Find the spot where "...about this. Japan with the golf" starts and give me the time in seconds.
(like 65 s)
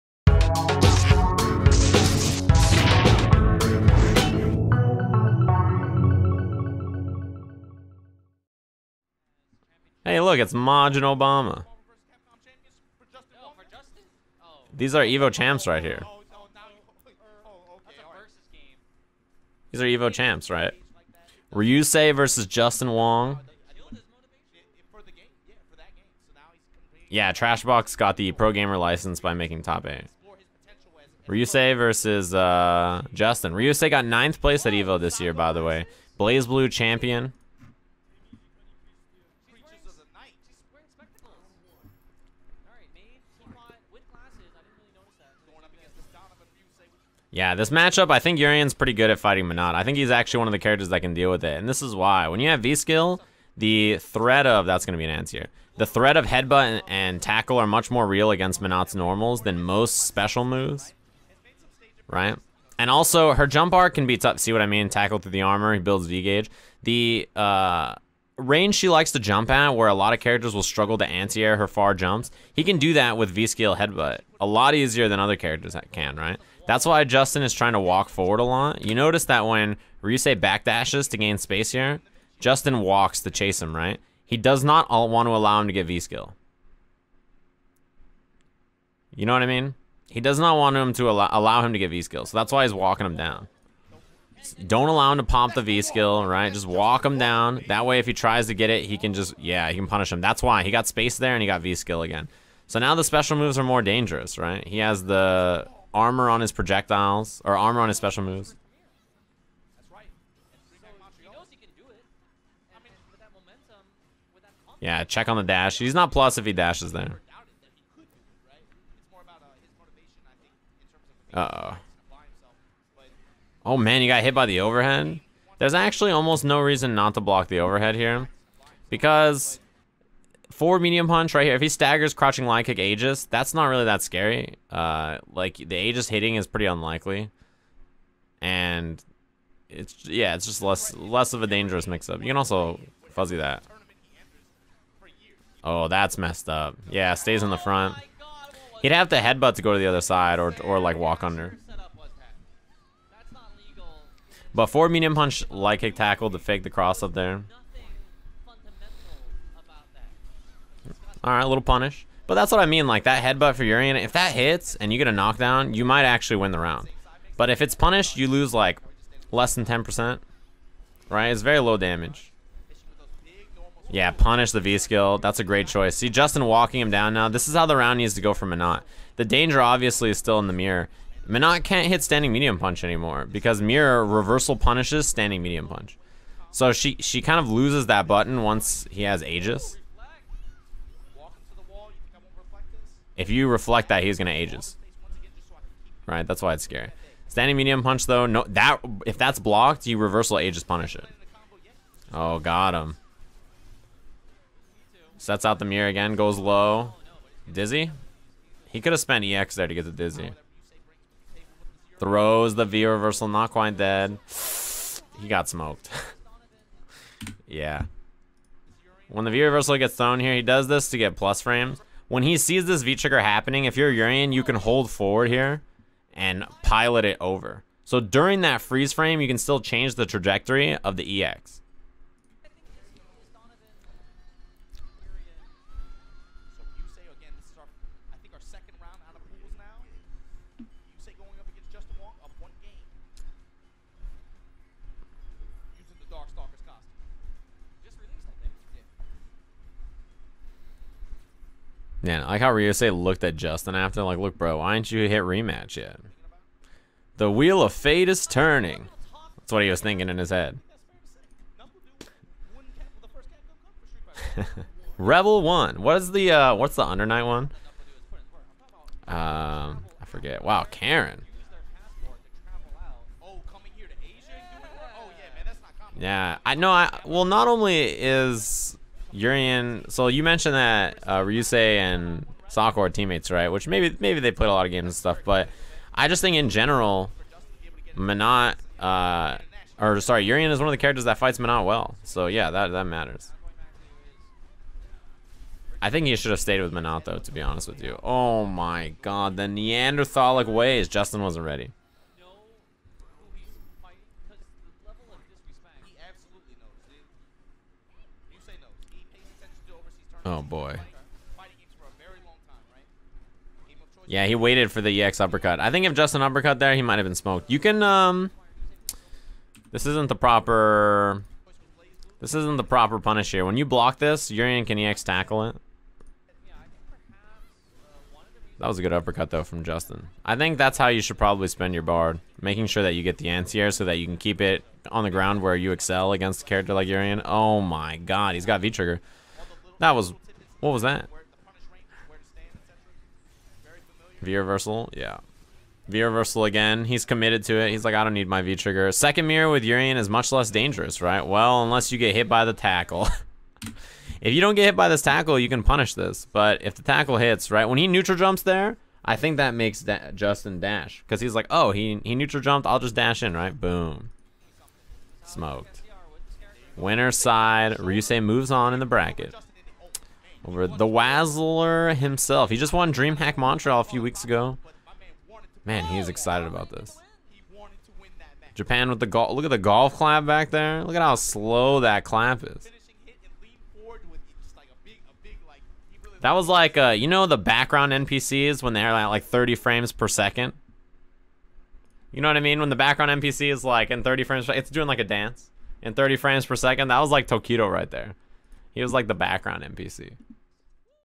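376 s.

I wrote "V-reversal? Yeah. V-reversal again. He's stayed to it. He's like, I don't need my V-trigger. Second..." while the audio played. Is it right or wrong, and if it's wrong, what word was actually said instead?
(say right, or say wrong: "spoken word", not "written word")
wrong: "committed", not "stayed".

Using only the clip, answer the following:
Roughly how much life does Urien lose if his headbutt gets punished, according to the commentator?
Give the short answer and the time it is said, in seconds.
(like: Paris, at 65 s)
less than 10%, at 169 s.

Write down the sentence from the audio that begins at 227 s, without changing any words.
So during that freeze frame, you can still change the trajectory of the EX.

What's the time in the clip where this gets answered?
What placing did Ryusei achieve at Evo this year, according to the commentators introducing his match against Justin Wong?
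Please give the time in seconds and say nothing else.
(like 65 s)
34 s.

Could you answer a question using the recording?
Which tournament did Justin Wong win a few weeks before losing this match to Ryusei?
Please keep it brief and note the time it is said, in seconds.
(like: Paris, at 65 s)
DreamHack Montreal, at 372 s.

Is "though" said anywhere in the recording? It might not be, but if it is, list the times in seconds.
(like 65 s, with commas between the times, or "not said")
198 s, 297 s, 329 s.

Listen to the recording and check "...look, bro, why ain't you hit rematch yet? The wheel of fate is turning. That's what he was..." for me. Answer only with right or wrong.
right.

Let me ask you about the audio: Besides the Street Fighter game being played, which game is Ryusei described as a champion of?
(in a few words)
BlazBlue.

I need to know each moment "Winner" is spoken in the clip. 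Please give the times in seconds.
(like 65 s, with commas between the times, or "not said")
366 s.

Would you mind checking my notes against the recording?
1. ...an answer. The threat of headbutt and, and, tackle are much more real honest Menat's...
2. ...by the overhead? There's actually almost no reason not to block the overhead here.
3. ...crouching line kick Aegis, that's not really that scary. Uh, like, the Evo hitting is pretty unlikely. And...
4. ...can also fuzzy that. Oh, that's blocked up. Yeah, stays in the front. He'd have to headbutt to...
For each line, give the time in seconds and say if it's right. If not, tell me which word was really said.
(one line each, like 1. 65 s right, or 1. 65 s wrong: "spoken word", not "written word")
1. 55 s wrong: "against", not "honest"
2. 124 s right
3. 132 s wrong: "Aegis", not "Evo"
4. 142 s wrong: "messed", not "blocked".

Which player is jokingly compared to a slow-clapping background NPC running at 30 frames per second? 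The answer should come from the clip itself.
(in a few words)
Tokido.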